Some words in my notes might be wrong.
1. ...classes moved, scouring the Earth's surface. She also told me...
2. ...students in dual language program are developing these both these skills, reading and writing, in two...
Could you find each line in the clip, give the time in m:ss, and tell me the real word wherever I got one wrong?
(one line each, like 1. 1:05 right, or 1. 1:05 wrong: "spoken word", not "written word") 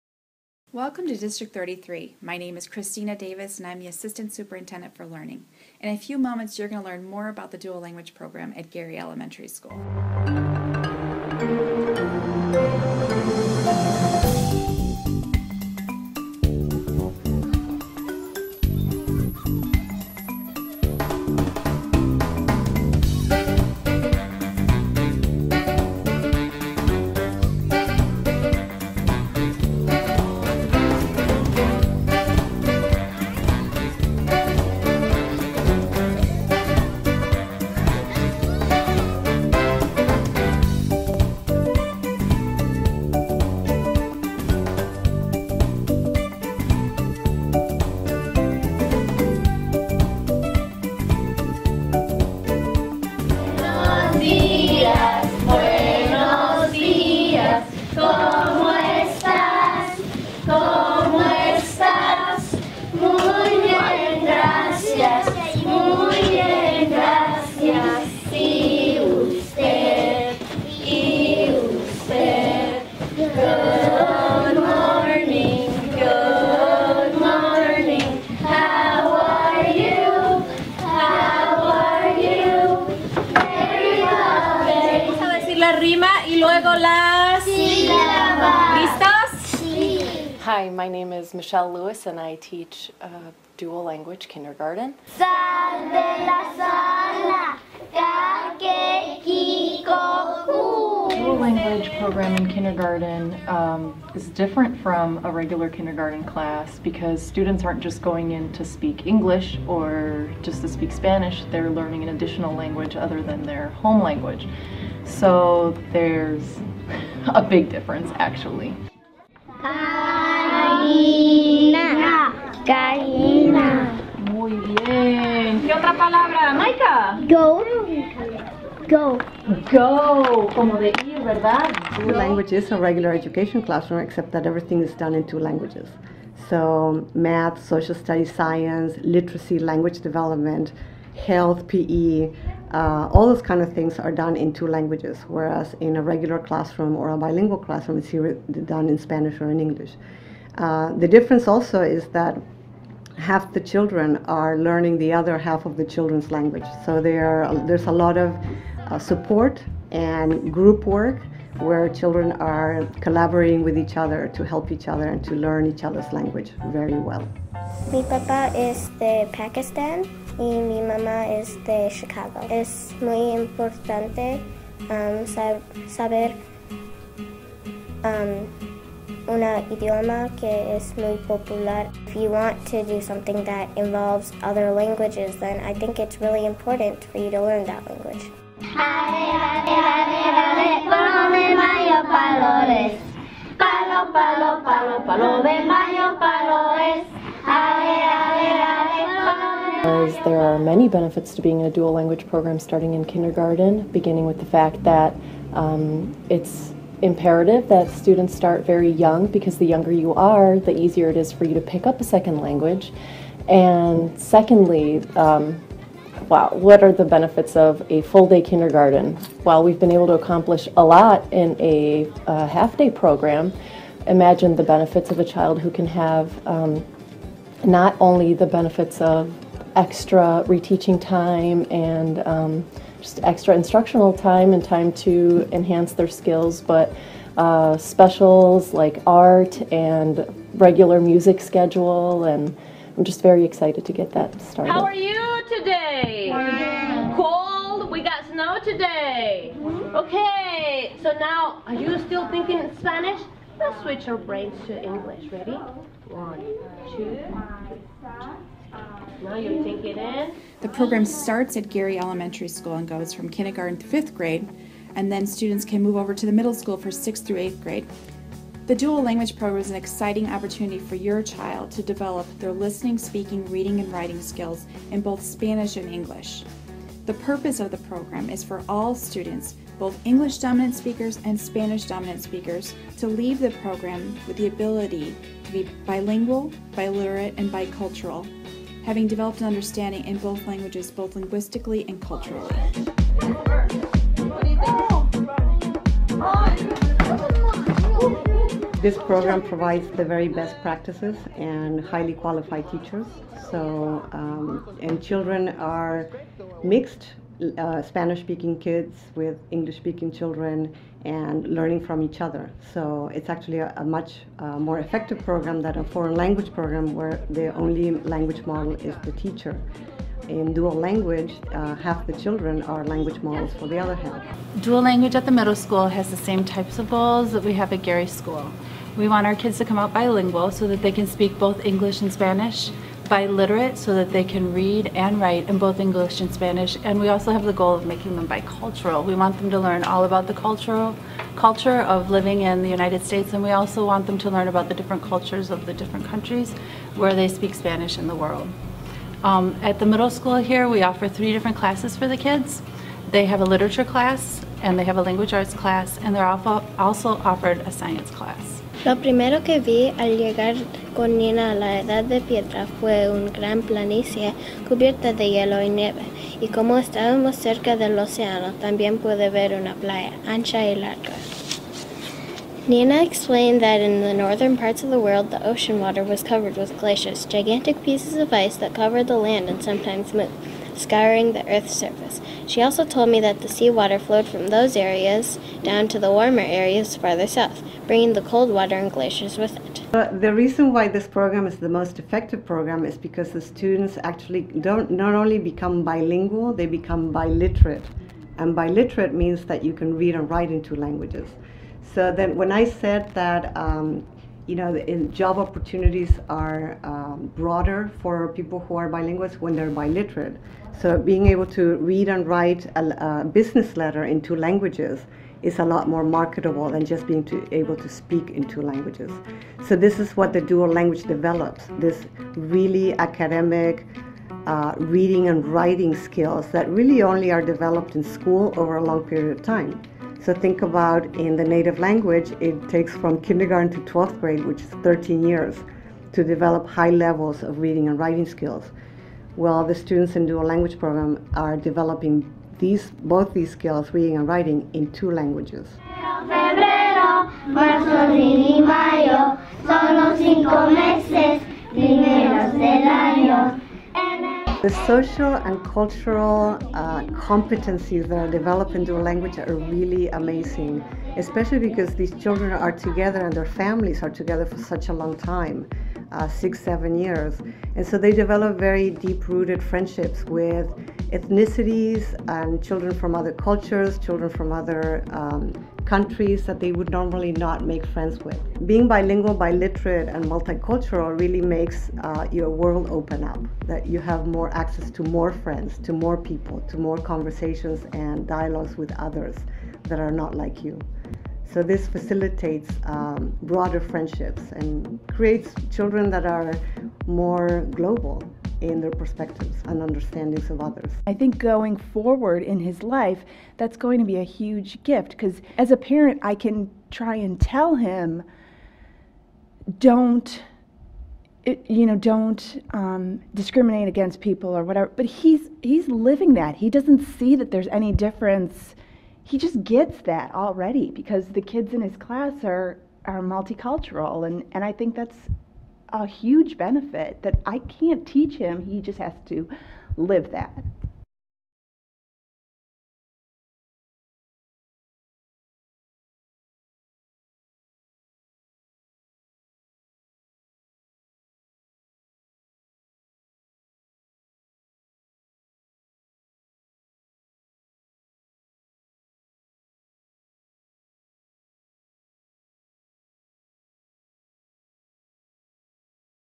1. 6:19 wrong: "sometimes", not "classes"
2. 7:19 right.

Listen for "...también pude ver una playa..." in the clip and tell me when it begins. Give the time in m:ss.
6:08.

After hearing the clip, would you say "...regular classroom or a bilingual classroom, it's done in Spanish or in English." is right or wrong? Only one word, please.
right.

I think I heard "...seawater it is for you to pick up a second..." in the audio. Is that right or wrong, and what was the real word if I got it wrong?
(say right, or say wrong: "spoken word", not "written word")
wrong: "easier", not "seawater".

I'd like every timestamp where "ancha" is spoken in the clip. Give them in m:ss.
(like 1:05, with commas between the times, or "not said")
6:10.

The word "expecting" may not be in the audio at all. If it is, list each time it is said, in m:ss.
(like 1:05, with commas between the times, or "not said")
not said.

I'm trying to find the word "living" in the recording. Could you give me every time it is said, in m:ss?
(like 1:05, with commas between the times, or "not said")
5:42, 8:35.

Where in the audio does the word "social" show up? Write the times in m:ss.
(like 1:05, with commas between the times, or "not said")
2:17, 7:34.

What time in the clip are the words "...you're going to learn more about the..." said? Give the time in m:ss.
0:06.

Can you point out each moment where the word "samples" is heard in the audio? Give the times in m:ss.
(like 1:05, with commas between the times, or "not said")
not said.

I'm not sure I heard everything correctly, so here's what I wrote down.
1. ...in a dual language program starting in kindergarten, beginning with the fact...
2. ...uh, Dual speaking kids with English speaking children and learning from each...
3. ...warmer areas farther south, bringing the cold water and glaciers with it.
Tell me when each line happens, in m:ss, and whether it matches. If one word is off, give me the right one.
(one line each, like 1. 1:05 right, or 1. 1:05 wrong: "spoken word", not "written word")
1. 3:21 right
2. 5:07 wrong: "Spanish", not "Dual"
3. 6:26 right.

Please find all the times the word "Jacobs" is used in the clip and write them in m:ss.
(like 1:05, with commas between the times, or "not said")
not said.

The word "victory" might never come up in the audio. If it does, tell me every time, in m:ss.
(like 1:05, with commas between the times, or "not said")
not said.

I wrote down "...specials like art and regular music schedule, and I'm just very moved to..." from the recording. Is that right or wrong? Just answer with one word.
wrong.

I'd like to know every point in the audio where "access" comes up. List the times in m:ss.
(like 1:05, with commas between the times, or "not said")
8:04.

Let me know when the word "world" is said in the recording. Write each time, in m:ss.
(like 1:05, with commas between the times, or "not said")
5:48, 6:14, 8:02.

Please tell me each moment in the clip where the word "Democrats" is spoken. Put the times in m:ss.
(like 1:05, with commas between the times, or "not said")
not said.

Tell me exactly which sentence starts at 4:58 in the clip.
This program provides the very best practices and highly qualified teachers.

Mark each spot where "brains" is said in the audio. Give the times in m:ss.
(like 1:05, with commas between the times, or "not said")
4:14.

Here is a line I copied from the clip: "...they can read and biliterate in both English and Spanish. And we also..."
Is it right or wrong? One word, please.
wrong.